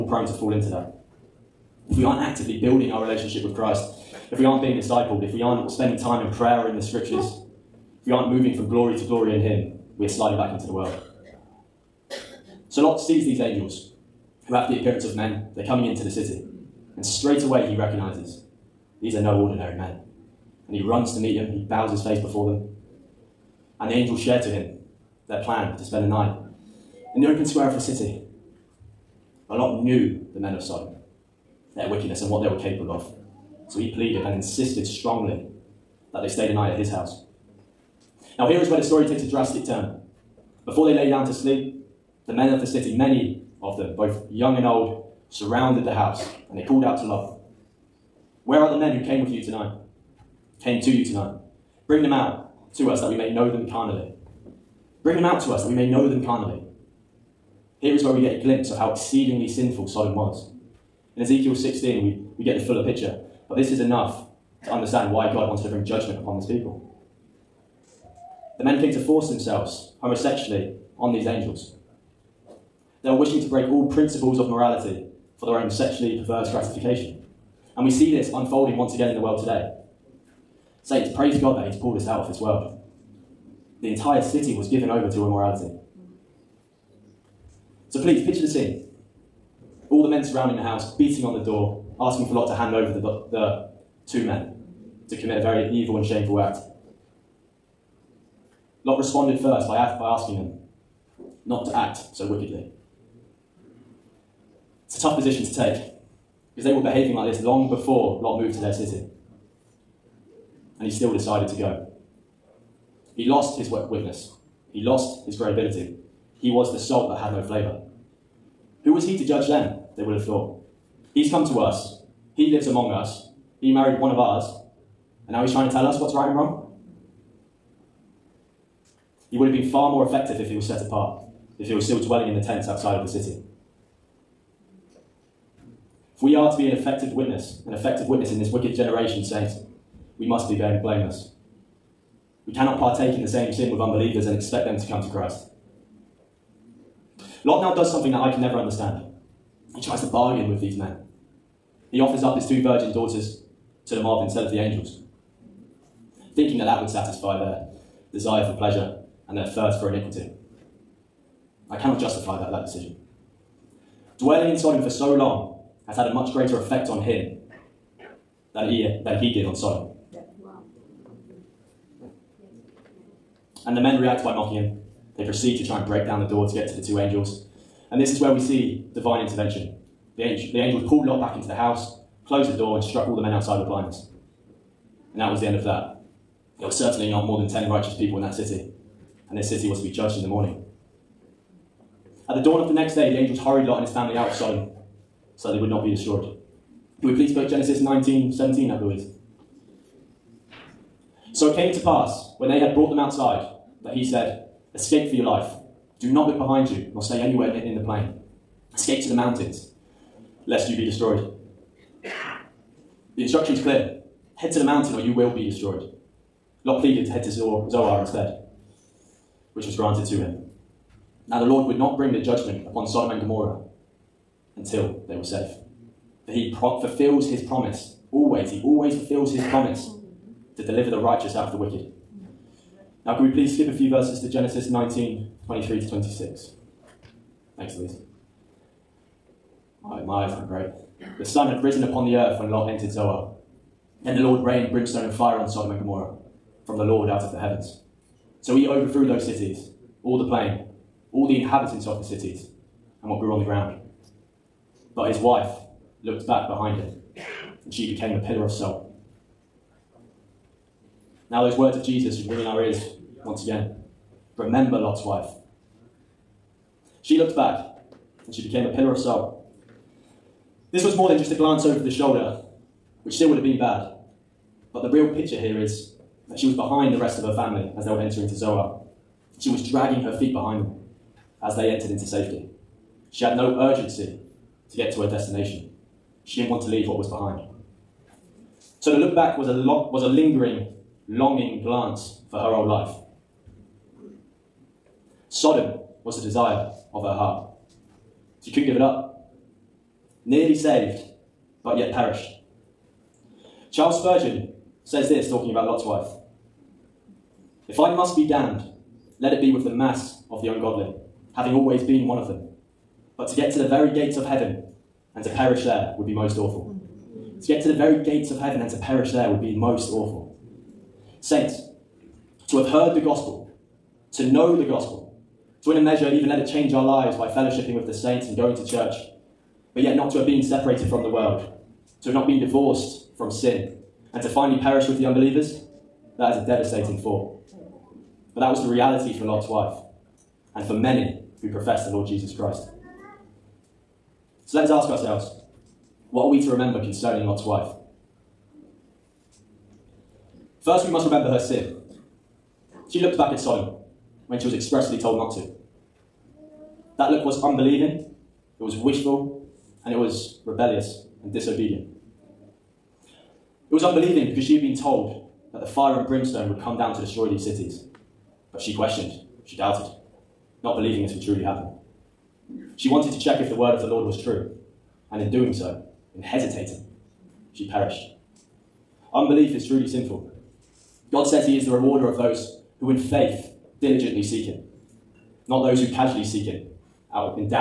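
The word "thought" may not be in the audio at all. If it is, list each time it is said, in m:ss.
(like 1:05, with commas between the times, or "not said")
2:00.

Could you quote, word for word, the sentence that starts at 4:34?
But the real picture here is that she was behind the rest of her family as they were entering to Zoar.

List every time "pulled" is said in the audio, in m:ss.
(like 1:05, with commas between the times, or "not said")
1:21, 3:00.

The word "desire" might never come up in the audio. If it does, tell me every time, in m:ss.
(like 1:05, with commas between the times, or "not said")
2:38, 4:56.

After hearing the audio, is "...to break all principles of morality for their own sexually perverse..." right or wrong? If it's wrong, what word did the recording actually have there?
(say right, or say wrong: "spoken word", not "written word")
right.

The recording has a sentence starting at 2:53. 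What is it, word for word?
And the men react by mocking him.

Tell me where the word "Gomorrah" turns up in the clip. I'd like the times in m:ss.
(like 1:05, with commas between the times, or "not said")
3:43, 4:05.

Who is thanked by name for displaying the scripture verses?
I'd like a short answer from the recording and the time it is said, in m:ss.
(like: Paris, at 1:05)
Louise, at 3:57.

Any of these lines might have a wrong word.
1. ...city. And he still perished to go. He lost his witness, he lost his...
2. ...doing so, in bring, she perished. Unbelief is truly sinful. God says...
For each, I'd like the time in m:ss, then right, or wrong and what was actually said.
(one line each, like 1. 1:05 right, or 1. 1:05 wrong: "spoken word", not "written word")
1. 1:48 wrong: "decided", not "perished"
2. 6:15 wrong: "hesitating", not "bring".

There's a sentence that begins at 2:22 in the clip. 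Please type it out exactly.
We cannot partake in the same sin with unbelievers and expect them to come to Christ.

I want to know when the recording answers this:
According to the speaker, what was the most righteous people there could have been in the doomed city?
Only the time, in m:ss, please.
3:07.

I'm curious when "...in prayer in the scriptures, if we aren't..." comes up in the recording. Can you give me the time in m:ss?
0:06.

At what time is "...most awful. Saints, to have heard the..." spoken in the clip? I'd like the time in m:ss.
5:19.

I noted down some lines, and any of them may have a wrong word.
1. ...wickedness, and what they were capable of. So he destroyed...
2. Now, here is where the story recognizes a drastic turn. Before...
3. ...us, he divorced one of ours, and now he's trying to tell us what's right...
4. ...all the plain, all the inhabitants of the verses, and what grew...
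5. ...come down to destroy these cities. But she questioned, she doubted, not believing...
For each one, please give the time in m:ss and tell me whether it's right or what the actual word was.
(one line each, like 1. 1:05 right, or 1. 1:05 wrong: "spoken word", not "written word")
1. 0:31 wrong: "pleaded", not "destroyed"
2. 0:38 wrong: "takes", not "recognizes"
3. 2:02 wrong: "married", not "divorced"
4. 4:10 wrong: "cities", not "verses"
5. 6:06 right.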